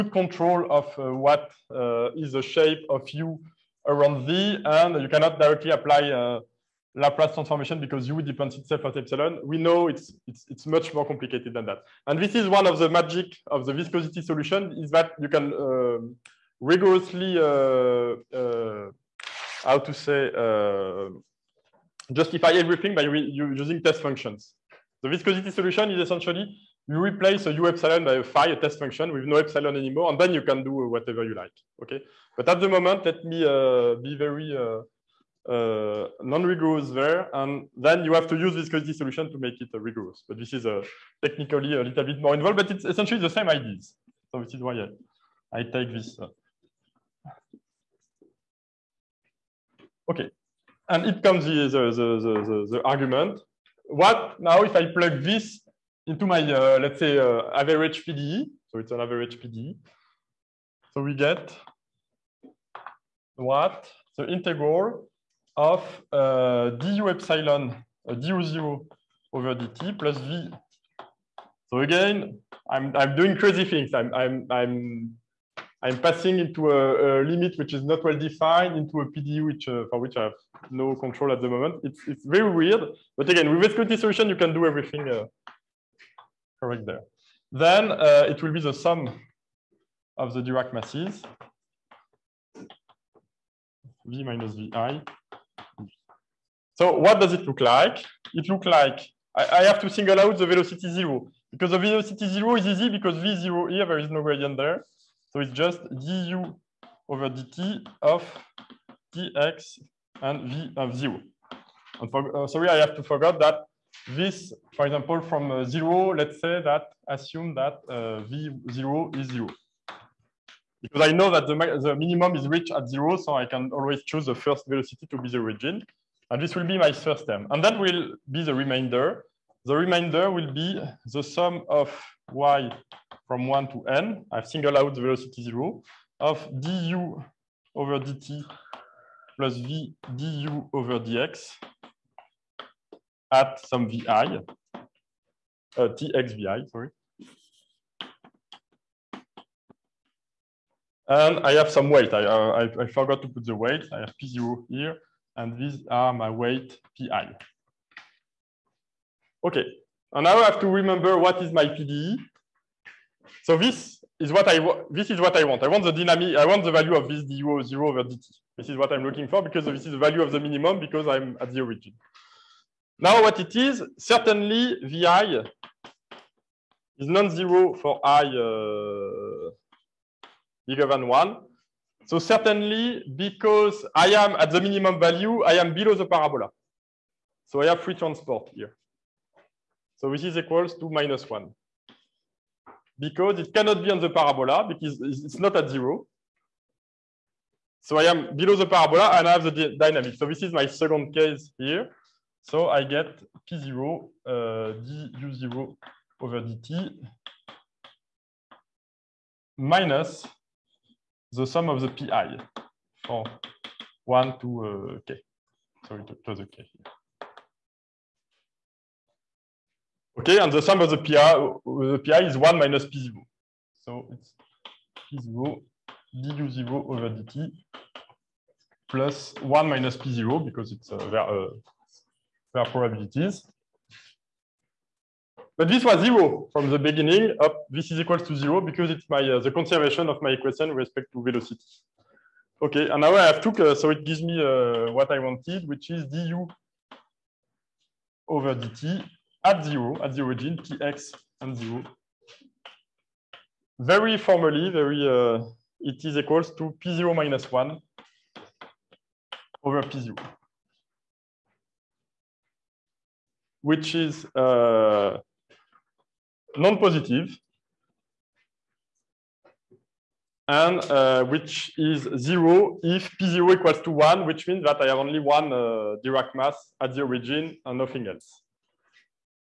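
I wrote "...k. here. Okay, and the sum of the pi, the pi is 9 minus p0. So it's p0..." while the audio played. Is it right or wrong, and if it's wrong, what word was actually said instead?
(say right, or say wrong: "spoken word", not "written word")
wrong: "1", not "9".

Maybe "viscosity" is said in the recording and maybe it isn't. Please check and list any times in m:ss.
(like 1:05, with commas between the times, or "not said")
0:13, 0:25, 0:38, 1:23.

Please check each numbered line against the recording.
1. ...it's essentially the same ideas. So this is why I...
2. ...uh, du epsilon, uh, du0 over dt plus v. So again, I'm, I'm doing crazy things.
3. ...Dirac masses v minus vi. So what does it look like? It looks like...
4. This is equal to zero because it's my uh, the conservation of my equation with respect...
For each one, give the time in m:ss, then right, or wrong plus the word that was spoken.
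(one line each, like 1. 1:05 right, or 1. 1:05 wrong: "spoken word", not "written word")
1. 0:42 right
2. 1:06 right
3. 1:30 right
4. 3:57 right.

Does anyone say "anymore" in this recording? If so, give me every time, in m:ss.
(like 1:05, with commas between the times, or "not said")
0:29.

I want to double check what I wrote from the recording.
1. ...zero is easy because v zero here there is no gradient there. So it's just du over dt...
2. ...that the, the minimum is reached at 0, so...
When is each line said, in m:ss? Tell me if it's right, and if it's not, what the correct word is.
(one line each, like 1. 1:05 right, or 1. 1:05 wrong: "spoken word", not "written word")
1. 1:42 right
2. 2:01 right.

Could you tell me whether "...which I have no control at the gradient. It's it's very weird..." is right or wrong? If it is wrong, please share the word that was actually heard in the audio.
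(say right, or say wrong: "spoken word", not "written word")
wrong: "moment", not "gradient".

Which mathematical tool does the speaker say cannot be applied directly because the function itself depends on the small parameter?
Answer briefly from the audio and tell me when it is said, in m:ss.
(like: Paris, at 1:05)
Laplace transformation, at 0:06.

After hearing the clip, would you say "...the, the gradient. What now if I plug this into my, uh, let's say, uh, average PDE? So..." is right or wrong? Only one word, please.
wrong.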